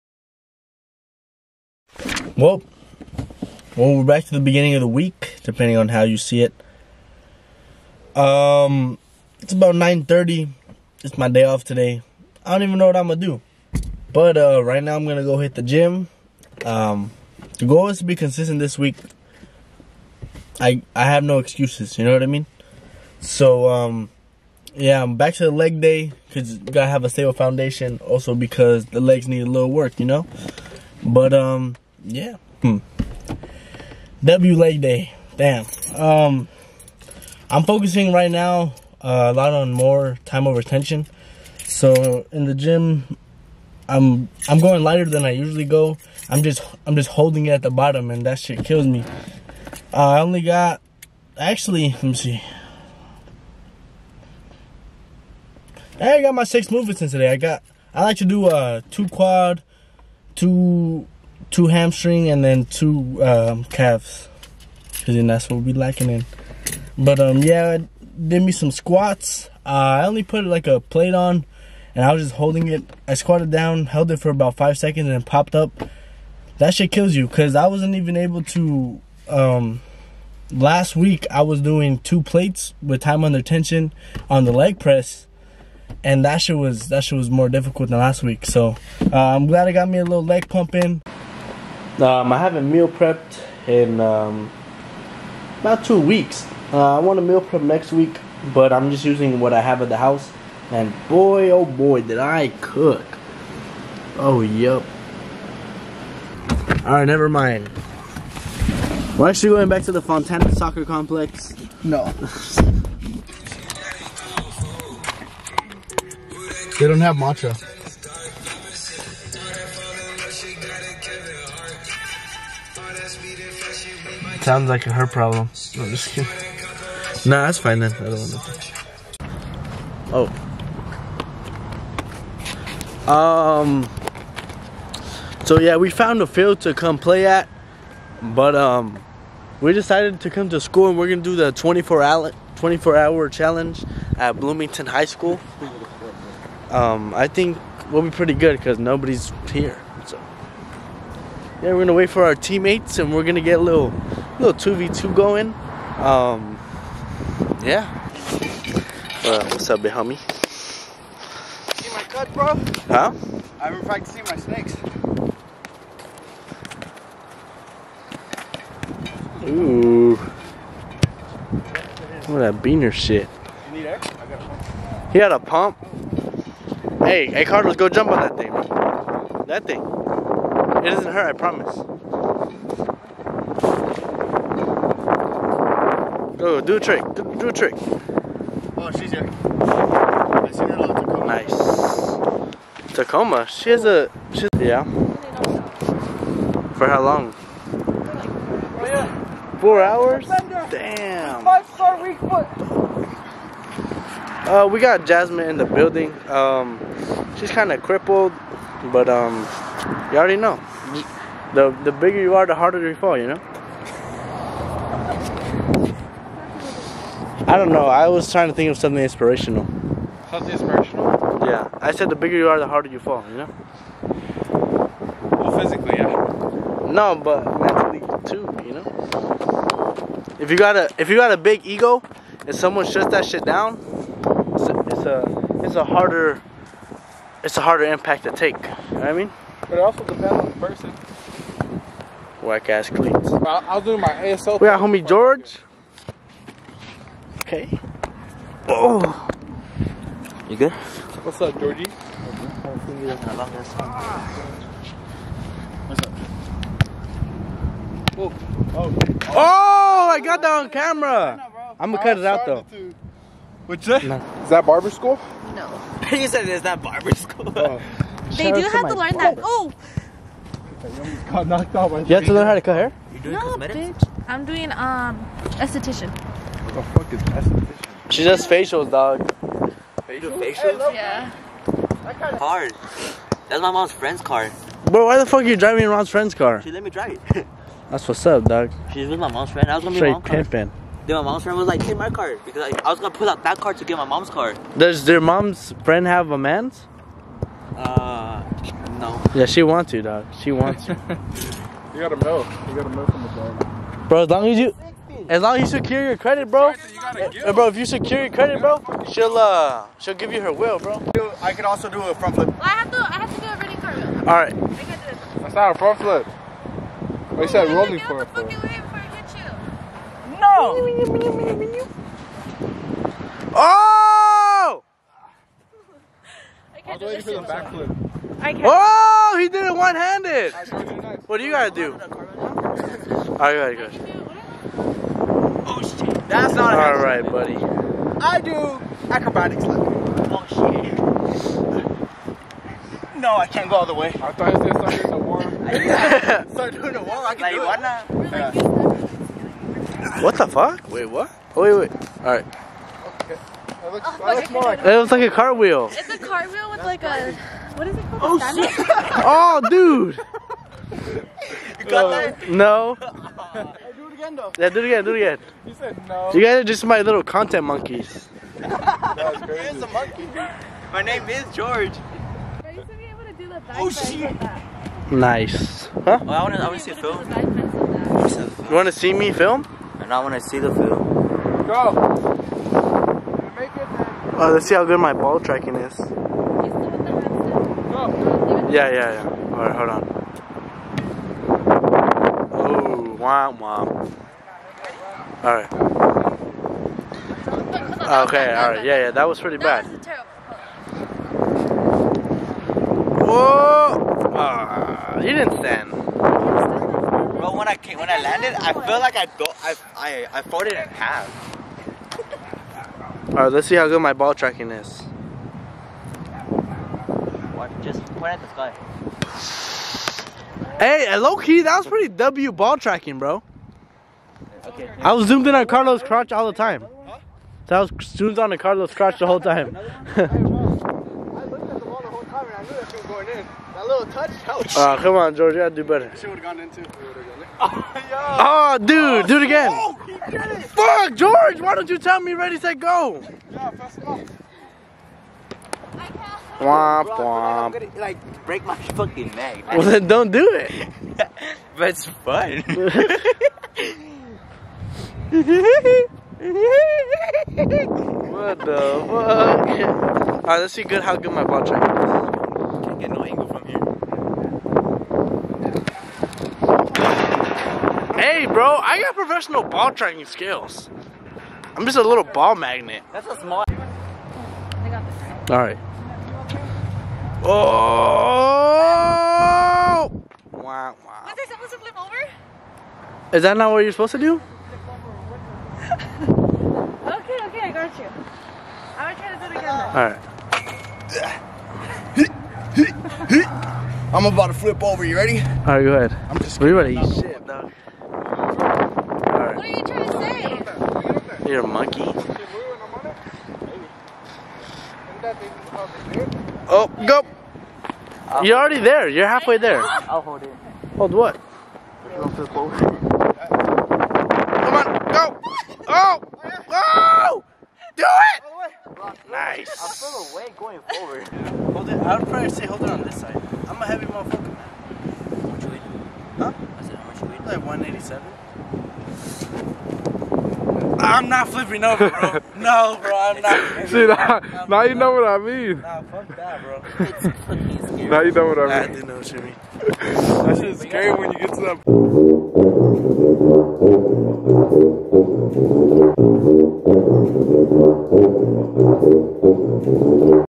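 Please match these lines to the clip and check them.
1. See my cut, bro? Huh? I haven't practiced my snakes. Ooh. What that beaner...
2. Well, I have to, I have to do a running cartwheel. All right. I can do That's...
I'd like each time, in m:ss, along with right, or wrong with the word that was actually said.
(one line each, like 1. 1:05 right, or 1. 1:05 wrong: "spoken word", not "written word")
1. 2:41 right
2. 5:12 right.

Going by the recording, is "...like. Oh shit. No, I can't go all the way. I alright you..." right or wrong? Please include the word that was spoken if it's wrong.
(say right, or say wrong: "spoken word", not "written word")
wrong: "thought", not "alright".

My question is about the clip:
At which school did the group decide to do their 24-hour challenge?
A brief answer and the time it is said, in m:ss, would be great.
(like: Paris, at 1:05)
Bloomington High School, at 2:24.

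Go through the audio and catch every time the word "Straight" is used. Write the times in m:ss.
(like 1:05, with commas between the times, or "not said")
4:49.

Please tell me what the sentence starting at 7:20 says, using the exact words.
Fuck, George, why don't you tell me ready, say go?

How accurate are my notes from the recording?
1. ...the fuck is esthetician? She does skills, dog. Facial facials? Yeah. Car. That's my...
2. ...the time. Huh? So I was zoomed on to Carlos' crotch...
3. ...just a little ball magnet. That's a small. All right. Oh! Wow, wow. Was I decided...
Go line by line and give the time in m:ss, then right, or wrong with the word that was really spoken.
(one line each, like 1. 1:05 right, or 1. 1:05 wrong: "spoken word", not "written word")
1. 4:36 wrong: "facials", not "skills"
2. 7:06 right
3. 7:51 wrong: "supposed", not "decided".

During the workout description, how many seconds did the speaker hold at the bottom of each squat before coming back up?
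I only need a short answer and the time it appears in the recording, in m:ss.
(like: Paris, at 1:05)
5 seconds, at 1:14.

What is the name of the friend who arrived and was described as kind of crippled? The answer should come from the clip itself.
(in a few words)
Jasmine.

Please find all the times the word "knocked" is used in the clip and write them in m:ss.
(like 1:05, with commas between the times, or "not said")
4:31.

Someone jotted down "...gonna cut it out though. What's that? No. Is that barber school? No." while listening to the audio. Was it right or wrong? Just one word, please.
right.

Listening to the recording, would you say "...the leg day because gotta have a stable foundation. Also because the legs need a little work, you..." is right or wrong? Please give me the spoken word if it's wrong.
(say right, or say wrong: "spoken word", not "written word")
right.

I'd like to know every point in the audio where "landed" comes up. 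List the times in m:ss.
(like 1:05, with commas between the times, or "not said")
6:48.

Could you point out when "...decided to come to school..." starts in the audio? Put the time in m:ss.
2:19.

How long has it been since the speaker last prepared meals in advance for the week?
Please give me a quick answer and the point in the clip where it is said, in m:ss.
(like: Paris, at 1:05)
2 weeks, at 1:35.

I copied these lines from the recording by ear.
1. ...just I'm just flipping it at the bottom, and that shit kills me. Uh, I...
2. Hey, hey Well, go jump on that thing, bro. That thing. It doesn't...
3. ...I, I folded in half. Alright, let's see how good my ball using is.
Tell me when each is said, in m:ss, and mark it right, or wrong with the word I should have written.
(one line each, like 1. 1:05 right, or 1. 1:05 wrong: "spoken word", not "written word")
1. 0:46 wrong: "holding", not "flipping"
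2. 2:57 wrong: "Carlos", not "Well"
3. 6:49 wrong: "tracking", not "using".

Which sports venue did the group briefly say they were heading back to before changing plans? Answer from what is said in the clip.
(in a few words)
Fontana Soccer Complex.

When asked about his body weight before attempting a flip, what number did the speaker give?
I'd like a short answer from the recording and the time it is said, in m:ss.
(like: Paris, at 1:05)
187, at 8:47.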